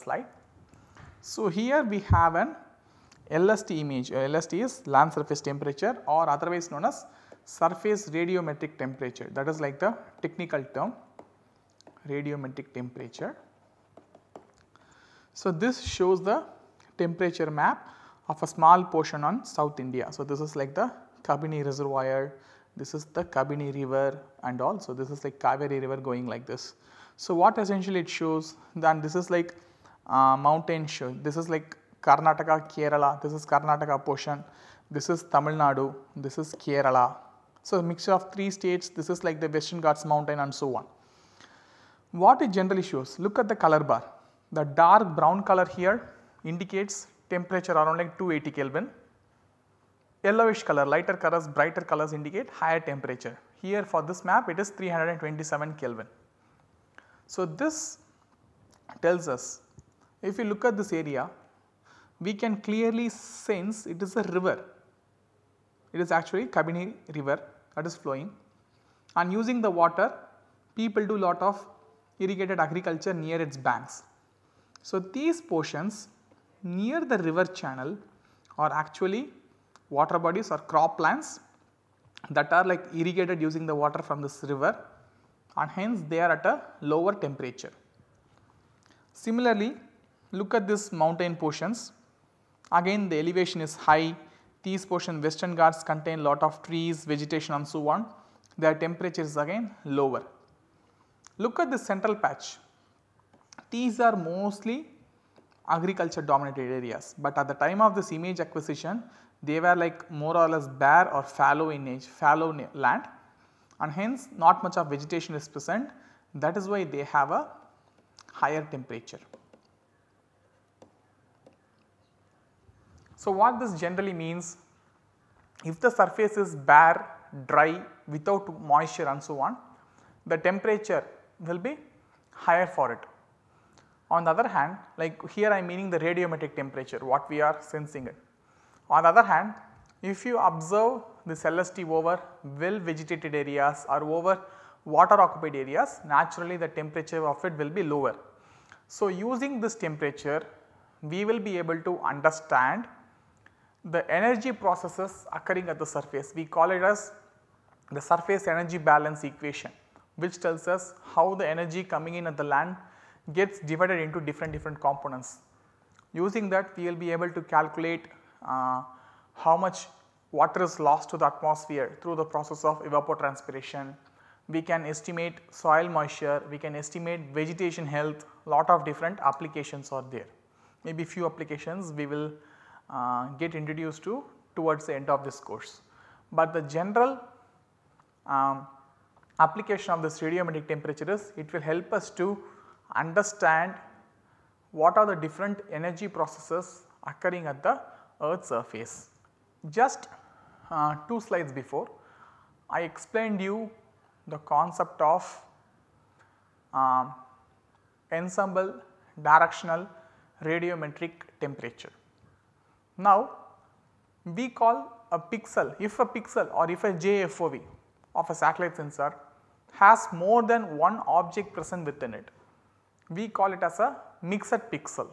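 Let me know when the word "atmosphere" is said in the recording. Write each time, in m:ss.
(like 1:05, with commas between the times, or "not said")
2:51.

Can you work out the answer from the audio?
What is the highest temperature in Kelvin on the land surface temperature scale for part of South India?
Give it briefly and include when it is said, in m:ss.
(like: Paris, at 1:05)
327 Kelvin, at 0:54.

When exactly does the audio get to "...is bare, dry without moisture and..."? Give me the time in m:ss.
2:06.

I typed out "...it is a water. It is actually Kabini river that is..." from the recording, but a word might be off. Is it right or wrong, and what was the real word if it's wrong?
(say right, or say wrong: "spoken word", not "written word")
wrong: "river", not "water".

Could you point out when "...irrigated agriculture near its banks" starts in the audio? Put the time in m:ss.
1:12.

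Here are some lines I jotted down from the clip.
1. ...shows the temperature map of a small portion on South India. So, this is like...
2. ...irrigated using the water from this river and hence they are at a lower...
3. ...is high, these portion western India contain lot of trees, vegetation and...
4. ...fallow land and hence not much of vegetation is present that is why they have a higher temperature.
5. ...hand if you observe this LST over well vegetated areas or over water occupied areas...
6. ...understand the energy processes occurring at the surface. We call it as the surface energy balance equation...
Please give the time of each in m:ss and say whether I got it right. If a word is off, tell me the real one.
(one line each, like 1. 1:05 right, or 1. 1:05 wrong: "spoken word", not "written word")
1. 0:15 right
2. 1:22 right
3. 1:33 wrong: "Ghats", not "India"
4. 1:52 right
5. 2:19 right
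6. 2:31 right.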